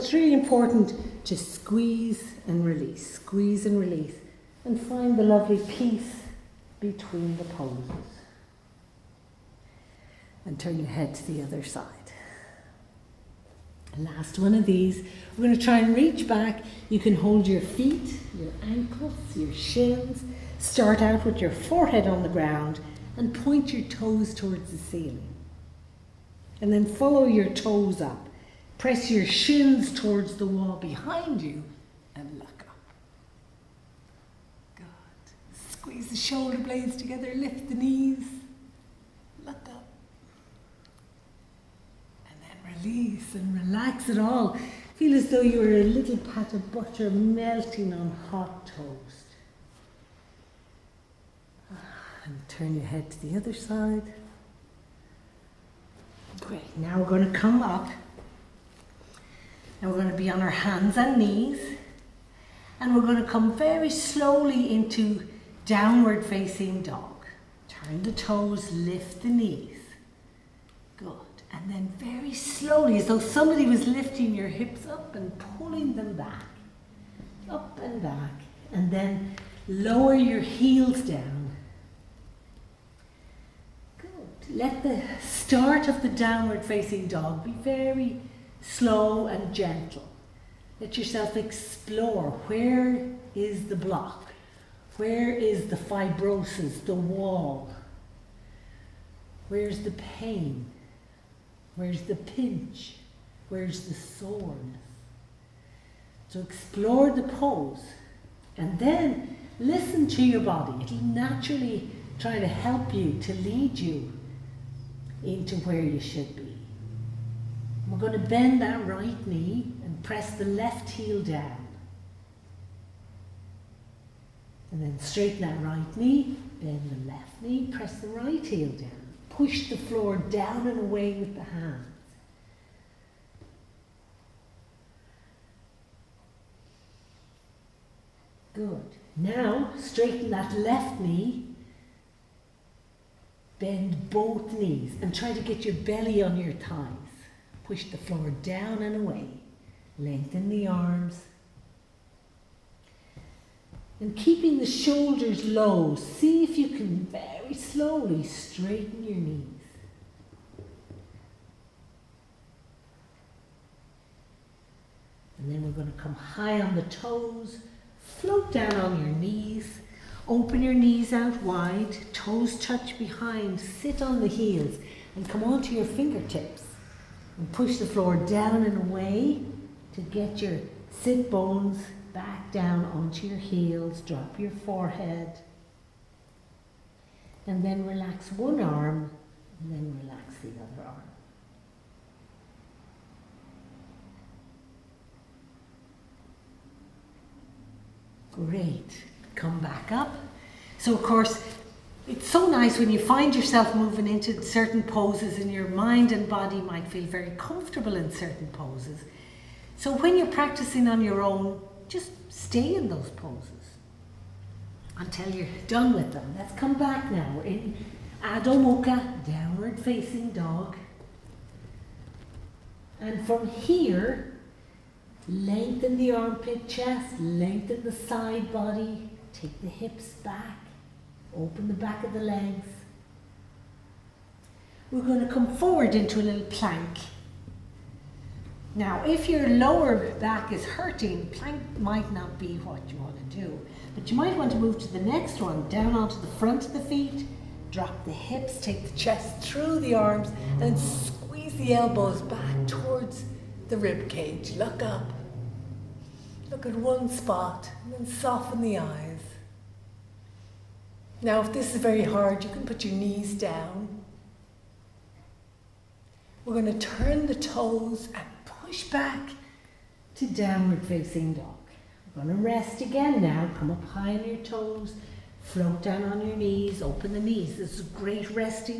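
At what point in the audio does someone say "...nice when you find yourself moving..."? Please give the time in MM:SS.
03:22.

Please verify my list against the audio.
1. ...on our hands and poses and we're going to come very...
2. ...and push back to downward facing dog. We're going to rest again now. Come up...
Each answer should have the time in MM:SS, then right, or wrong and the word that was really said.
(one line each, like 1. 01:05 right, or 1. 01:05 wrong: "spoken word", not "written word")
1. 01:00 wrong: "knees", not "poses"
2. 04:28 right.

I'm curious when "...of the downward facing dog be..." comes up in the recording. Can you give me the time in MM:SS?
01:25.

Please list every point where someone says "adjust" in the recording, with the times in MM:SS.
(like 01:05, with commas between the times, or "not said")
not said.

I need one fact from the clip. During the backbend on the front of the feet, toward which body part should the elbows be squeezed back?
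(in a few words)
the rib cage.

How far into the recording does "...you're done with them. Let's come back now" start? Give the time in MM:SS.
03:35.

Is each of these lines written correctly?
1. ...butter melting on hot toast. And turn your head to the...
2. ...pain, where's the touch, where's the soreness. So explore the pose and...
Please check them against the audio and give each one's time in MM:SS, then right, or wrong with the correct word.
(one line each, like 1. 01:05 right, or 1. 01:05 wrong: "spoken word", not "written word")
1. 00:46 right
2. 01:39 wrong: "pinch", not "touch".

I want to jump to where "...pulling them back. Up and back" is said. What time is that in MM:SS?
01:15.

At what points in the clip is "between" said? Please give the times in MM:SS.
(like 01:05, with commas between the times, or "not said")
00:06.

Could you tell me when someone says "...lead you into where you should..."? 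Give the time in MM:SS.
01:53.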